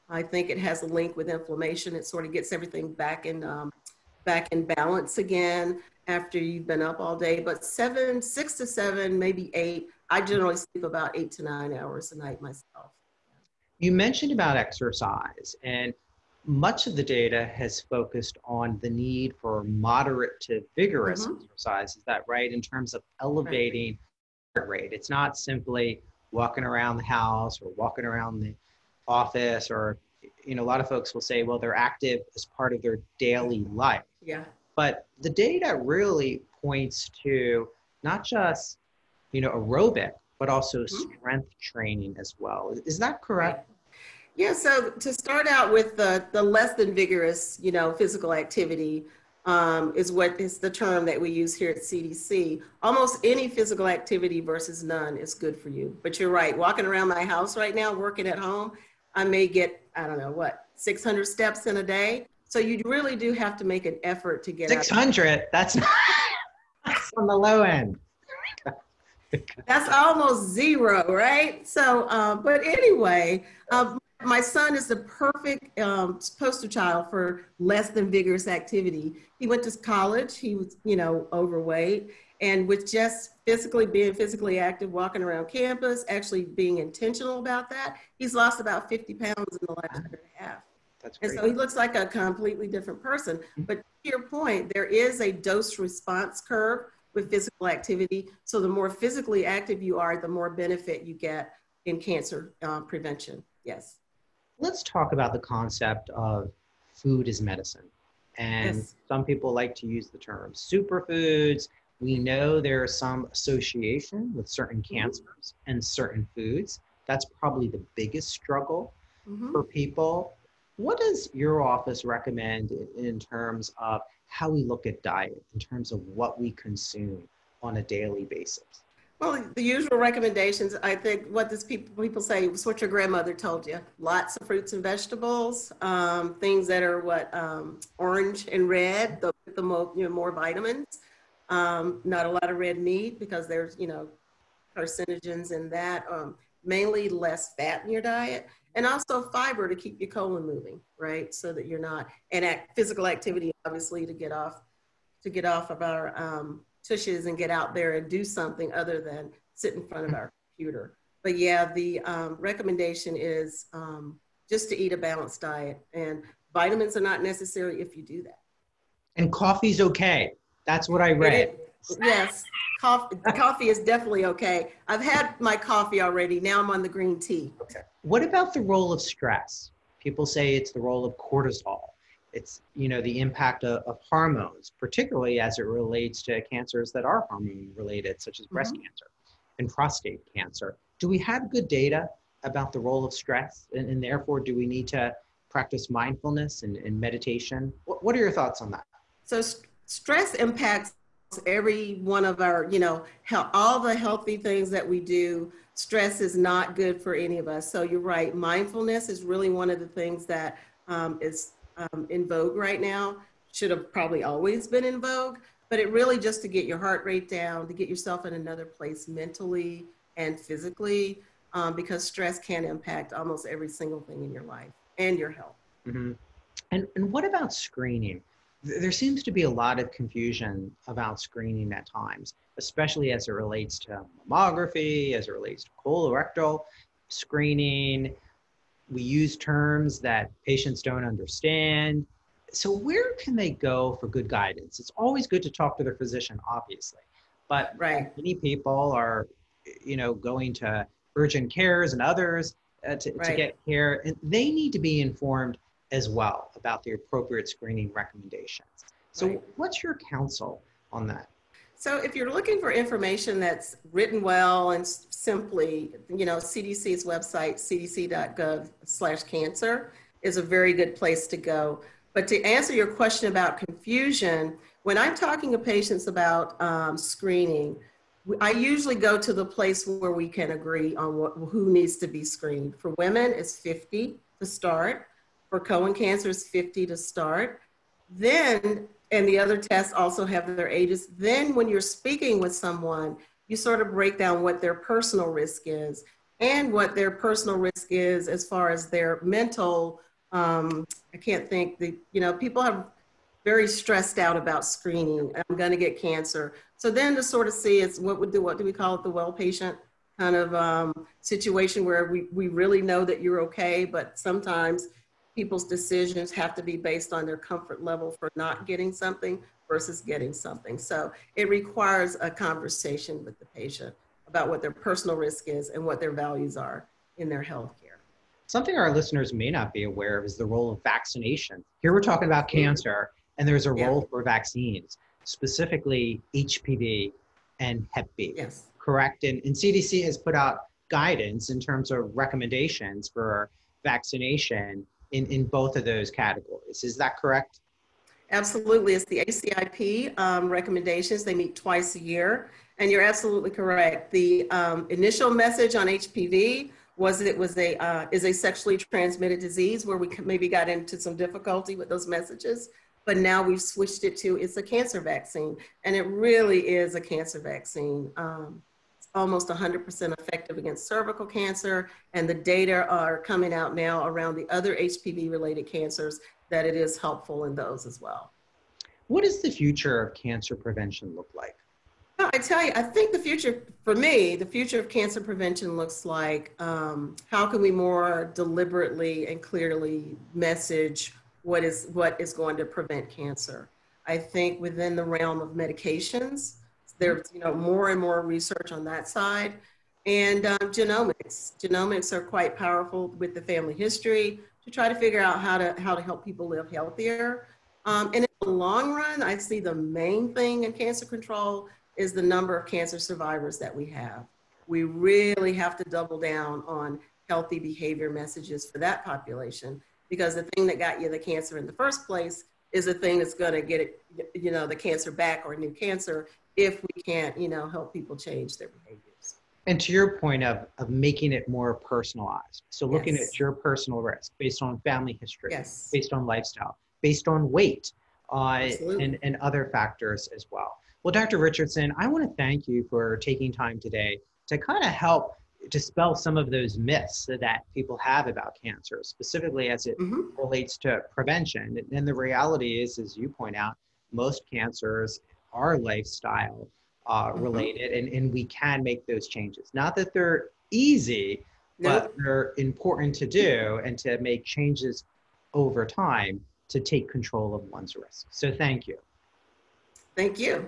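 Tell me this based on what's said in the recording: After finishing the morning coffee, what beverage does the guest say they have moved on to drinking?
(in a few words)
green tea.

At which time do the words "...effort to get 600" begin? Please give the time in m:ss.
1:04.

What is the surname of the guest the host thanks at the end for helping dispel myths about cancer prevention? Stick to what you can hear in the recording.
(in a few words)
Richardson.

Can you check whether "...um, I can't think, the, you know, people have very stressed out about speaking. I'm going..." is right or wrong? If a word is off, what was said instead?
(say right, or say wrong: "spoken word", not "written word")
wrong: "screening", not "speaking".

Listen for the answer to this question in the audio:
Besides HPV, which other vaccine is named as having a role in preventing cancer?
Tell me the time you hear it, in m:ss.
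5:37.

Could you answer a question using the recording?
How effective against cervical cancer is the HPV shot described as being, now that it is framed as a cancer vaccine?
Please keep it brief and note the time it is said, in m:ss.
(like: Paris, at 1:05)
almost 100%, at 6:09.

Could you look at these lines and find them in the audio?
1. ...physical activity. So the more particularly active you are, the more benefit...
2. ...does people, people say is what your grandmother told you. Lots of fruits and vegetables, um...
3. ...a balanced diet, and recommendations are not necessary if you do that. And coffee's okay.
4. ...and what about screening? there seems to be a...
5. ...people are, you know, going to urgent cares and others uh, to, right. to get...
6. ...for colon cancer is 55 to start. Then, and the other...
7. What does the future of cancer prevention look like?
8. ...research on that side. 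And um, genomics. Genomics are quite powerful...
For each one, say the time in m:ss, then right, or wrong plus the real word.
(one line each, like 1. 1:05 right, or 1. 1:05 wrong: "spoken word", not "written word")
1. 1:37 wrong: "physically", not "particularly"
2. 2:11 right
3. 2:44 wrong: "vitamins", not "recommendations"
4. 3:46 right
5. 4:08 right
6. 4:45 wrong: "50", not "55"
7. 6:19 right
8. 6:38 right.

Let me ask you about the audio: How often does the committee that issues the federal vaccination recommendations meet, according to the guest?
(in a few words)
twice a year.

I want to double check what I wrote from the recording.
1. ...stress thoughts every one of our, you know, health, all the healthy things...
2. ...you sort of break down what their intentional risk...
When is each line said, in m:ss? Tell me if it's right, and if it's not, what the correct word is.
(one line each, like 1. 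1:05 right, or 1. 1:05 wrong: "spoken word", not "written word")
1. 3:19 wrong: "impacts", not "thoughts"
2. 4:53 wrong: "personal", not "intentional".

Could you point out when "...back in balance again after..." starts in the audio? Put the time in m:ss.
0:04.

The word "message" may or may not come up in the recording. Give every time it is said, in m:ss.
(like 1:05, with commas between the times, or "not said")
5:55, 6:02, 6:30, 6:58.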